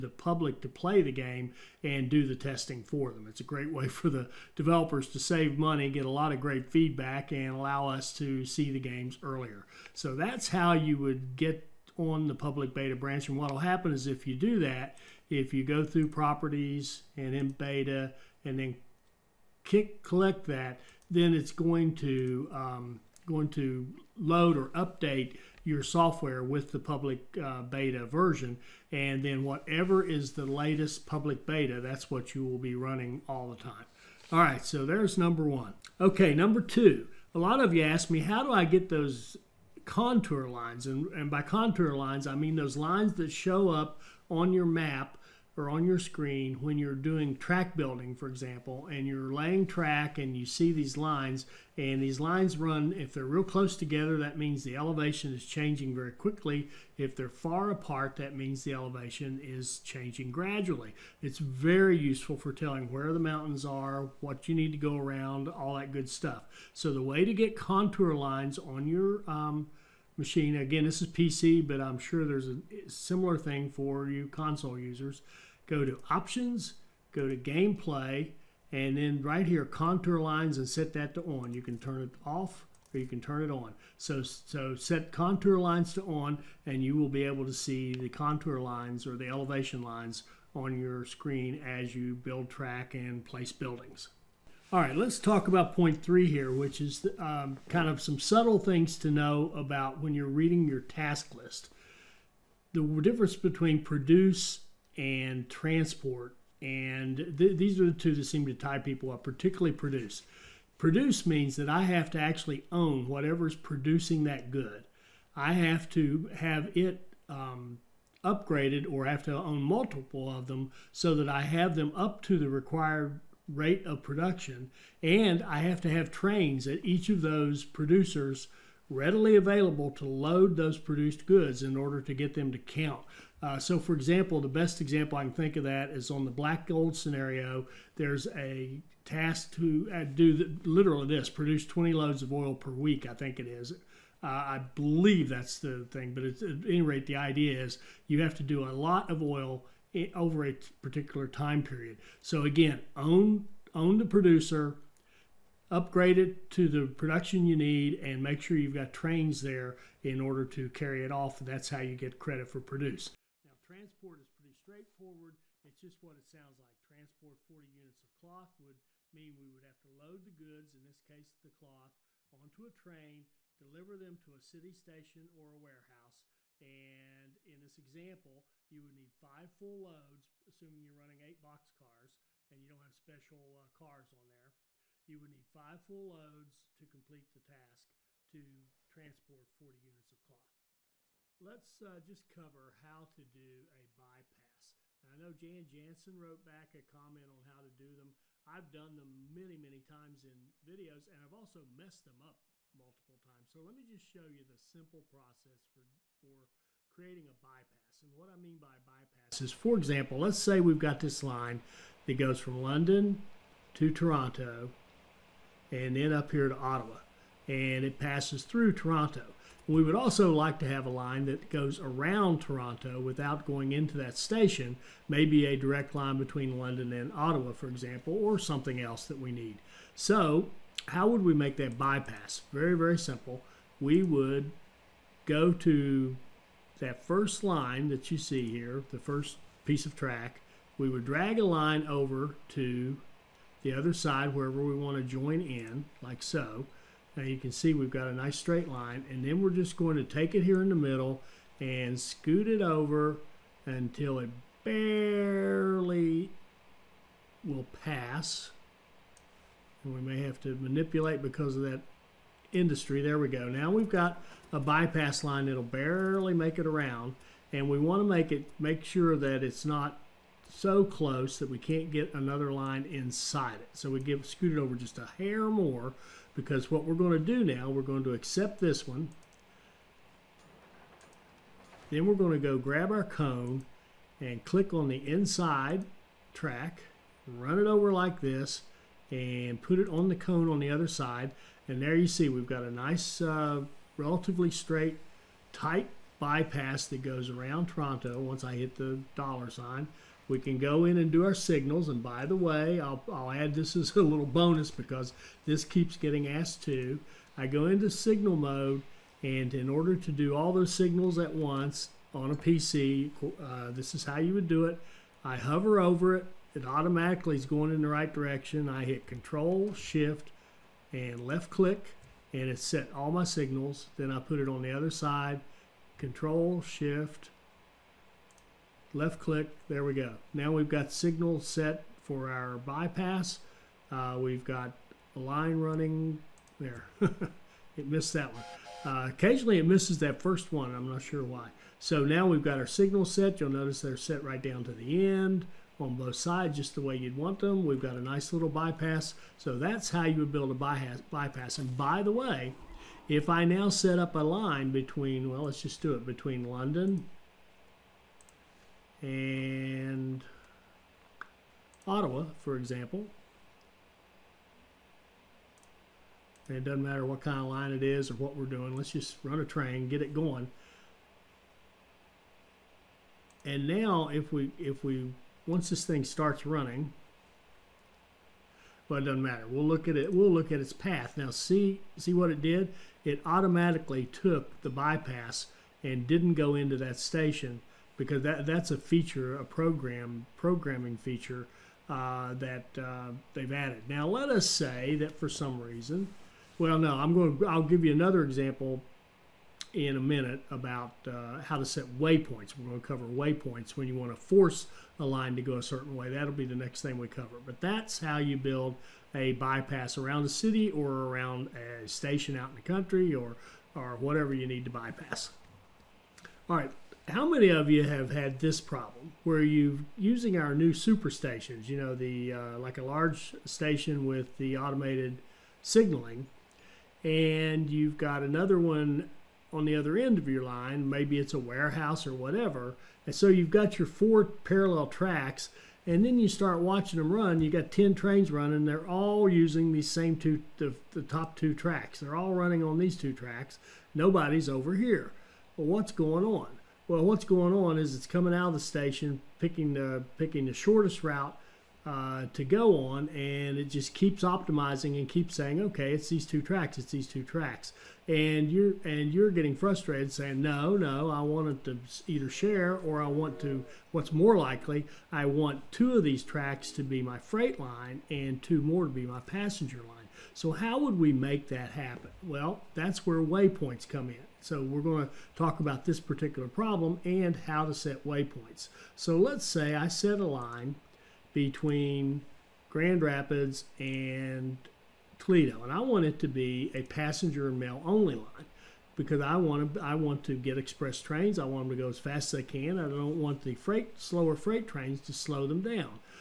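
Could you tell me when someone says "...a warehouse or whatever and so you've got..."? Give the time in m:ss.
7:11.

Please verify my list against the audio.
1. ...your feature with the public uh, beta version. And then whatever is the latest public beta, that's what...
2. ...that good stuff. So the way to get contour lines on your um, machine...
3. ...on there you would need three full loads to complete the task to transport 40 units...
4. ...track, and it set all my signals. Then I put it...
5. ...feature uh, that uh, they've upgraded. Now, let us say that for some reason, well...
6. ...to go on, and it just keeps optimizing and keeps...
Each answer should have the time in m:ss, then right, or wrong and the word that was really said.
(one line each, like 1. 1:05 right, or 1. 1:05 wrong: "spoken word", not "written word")
1. 0:25 wrong: "software", not "feature"
2. 1:05 right
3. 3:04 wrong: "five", not "three"
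4. 5:21 wrong: "click", not "track"
5. 6:30 wrong: "added", not "upgraded"
6. 7:32 right.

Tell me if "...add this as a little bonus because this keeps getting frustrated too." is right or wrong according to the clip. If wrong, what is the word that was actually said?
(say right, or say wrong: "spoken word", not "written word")
wrong: "asked", not "frustrated".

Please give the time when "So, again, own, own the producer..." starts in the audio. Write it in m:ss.
2:32.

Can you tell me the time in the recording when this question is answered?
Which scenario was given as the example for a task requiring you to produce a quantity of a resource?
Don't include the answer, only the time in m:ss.
2:16.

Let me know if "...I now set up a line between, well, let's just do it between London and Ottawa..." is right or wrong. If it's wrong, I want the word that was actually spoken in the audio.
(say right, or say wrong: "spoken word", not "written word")
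right.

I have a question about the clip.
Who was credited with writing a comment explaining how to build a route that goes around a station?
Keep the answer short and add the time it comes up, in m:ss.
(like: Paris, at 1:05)
Jan Jansen, at 3:15.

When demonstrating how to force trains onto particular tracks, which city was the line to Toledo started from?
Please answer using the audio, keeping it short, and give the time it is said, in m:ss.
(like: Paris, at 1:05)
Grand Rapids, at 8:02.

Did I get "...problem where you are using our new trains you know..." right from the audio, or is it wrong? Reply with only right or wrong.
wrong.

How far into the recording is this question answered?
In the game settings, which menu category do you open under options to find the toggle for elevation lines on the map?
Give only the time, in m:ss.
1:17.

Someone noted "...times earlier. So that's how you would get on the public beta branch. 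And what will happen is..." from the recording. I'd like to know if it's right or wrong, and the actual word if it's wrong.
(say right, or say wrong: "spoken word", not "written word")
wrong: "games", not "times".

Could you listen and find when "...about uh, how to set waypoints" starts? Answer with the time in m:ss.
6:40.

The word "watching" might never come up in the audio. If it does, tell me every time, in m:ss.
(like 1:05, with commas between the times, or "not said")
7:16.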